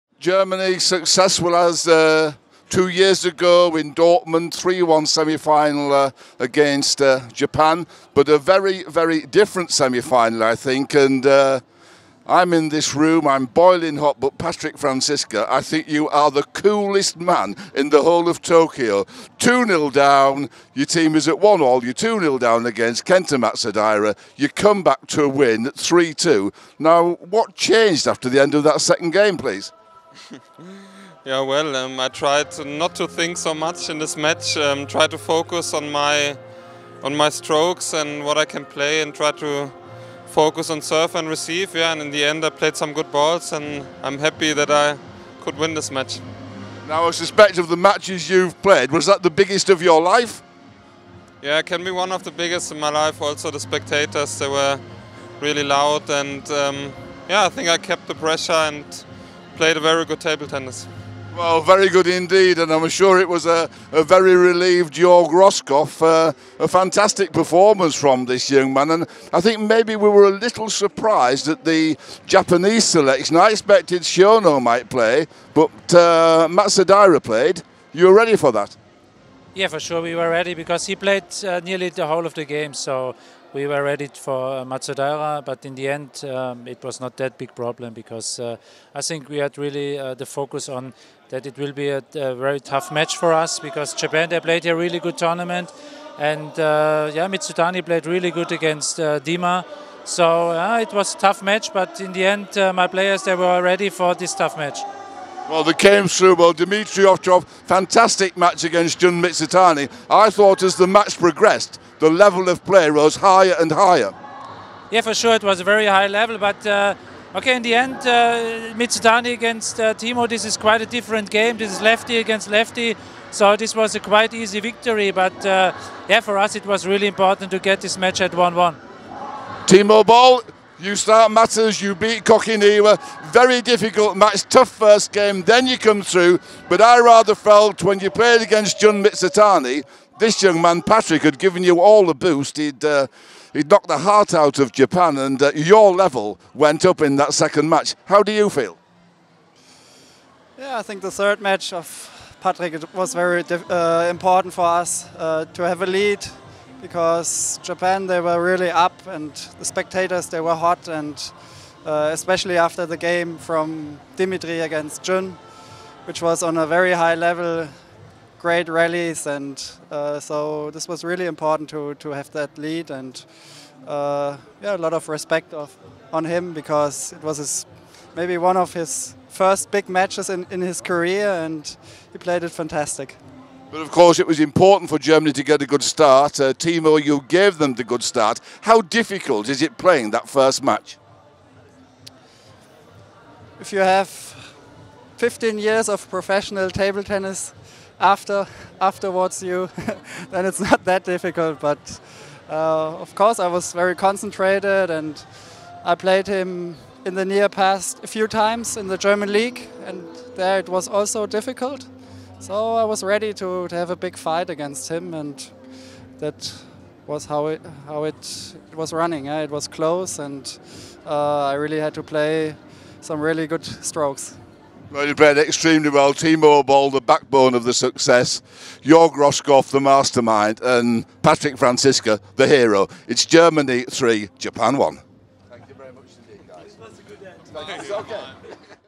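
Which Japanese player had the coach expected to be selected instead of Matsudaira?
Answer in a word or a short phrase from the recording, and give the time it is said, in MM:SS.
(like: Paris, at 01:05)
Shono, at 01:14.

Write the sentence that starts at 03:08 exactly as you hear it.
How difficult is it playing that first match?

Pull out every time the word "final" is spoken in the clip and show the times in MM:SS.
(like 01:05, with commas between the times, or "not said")
00:05, 00:09.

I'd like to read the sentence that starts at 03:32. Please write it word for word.
So I was ready to, to have a big fight against him, and that was how it how it, it was running.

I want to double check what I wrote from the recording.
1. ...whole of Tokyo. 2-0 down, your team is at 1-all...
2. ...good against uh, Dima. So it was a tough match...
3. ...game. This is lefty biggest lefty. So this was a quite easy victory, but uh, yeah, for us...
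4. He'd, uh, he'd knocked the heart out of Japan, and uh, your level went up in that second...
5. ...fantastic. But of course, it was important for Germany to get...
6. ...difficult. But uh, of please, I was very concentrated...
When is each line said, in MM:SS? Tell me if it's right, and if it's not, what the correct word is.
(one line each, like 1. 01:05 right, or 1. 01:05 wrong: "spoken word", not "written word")
1. 00:18 right
2. 01:38 right
3. 02:01 wrong: "against", not "biggest"
4. 02:22 right
5. 03:02 right
6. 03:21 wrong: "course", not "please".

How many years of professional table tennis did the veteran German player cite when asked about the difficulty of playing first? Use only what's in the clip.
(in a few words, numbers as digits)
15.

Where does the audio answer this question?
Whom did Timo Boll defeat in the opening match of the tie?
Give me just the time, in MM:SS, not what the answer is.
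02:12.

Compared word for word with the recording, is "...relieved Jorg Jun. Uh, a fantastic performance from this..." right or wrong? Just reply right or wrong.
wrong.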